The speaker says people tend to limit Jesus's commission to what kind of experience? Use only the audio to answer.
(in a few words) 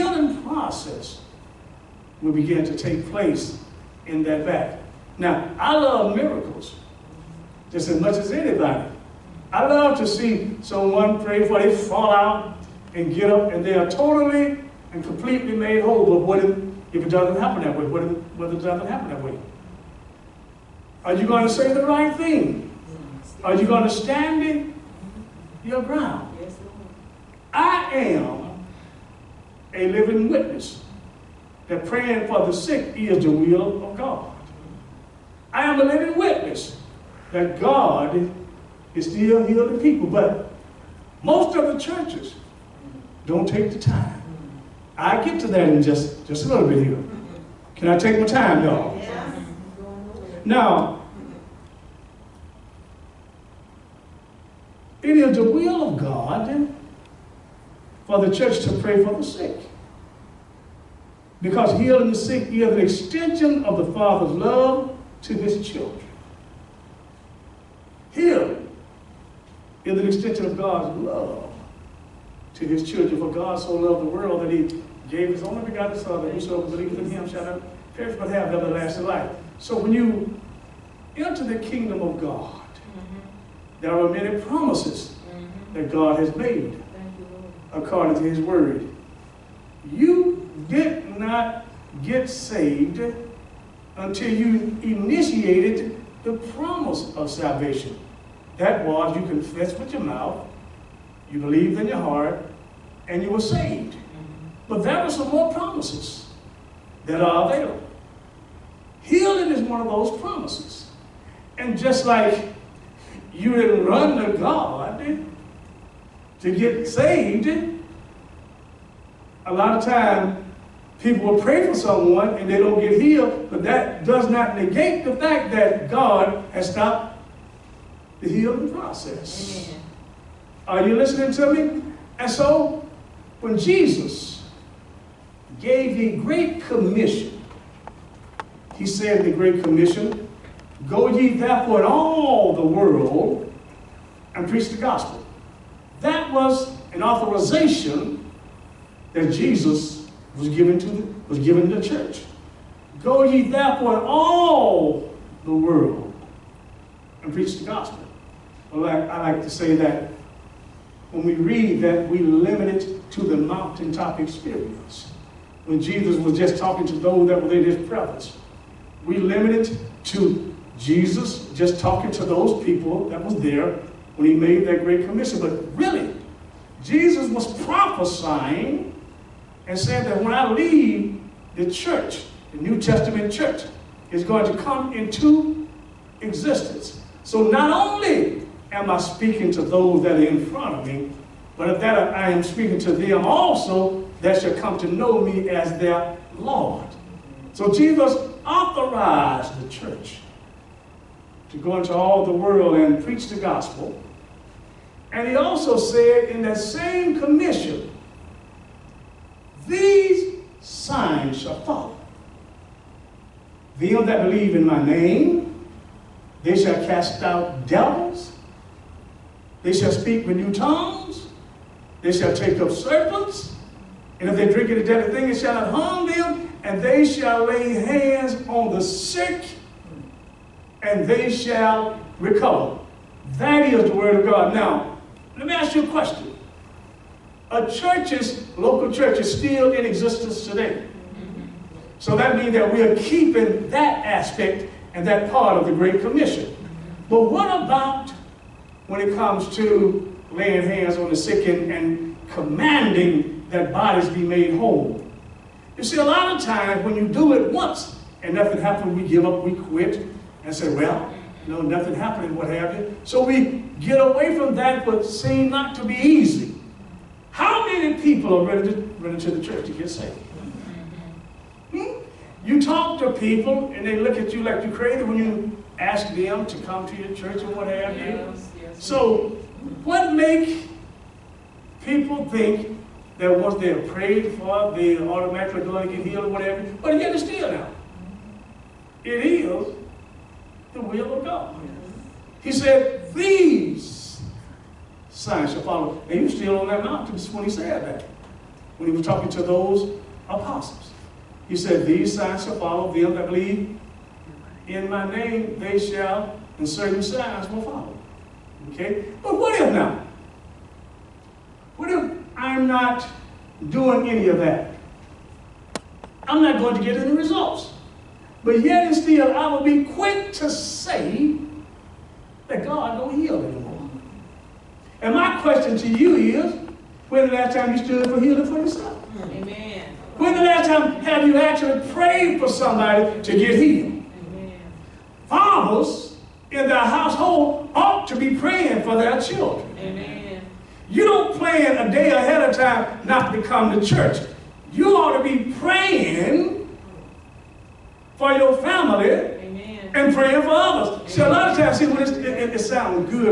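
Mountaintop experience.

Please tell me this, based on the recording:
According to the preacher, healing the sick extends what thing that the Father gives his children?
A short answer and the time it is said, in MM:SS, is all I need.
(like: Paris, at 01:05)
The Father's love, at 01:03.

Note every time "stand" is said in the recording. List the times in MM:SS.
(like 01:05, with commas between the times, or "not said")
00:23.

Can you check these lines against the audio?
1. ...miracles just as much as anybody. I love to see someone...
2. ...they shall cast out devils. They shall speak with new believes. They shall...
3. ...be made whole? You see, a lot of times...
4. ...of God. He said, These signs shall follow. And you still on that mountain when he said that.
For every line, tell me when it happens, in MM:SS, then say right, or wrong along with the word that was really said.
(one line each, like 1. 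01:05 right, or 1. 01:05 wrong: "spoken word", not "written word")
1. 00:06 right
2. 03:36 wrong: "tongues", not "believes"
3. 04:14 right
4. 04:51 right.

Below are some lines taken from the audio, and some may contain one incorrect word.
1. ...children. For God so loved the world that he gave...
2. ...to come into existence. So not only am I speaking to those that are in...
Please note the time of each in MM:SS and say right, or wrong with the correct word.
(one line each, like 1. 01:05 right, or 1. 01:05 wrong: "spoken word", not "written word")
1. 01:12 right
2. 03:04 right.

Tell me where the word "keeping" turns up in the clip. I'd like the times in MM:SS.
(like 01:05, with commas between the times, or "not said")
04:02.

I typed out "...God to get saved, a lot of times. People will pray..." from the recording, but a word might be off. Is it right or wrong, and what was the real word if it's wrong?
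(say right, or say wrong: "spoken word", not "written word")
right.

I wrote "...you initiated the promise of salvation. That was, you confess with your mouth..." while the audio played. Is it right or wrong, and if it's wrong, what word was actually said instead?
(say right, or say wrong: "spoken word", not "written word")
right.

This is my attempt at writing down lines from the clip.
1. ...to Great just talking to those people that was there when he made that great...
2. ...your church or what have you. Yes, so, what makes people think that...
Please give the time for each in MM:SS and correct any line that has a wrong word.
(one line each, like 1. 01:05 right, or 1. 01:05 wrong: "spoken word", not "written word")
1. 02:50 wrong: "Jesus", not "Great"
2. 04:36 right.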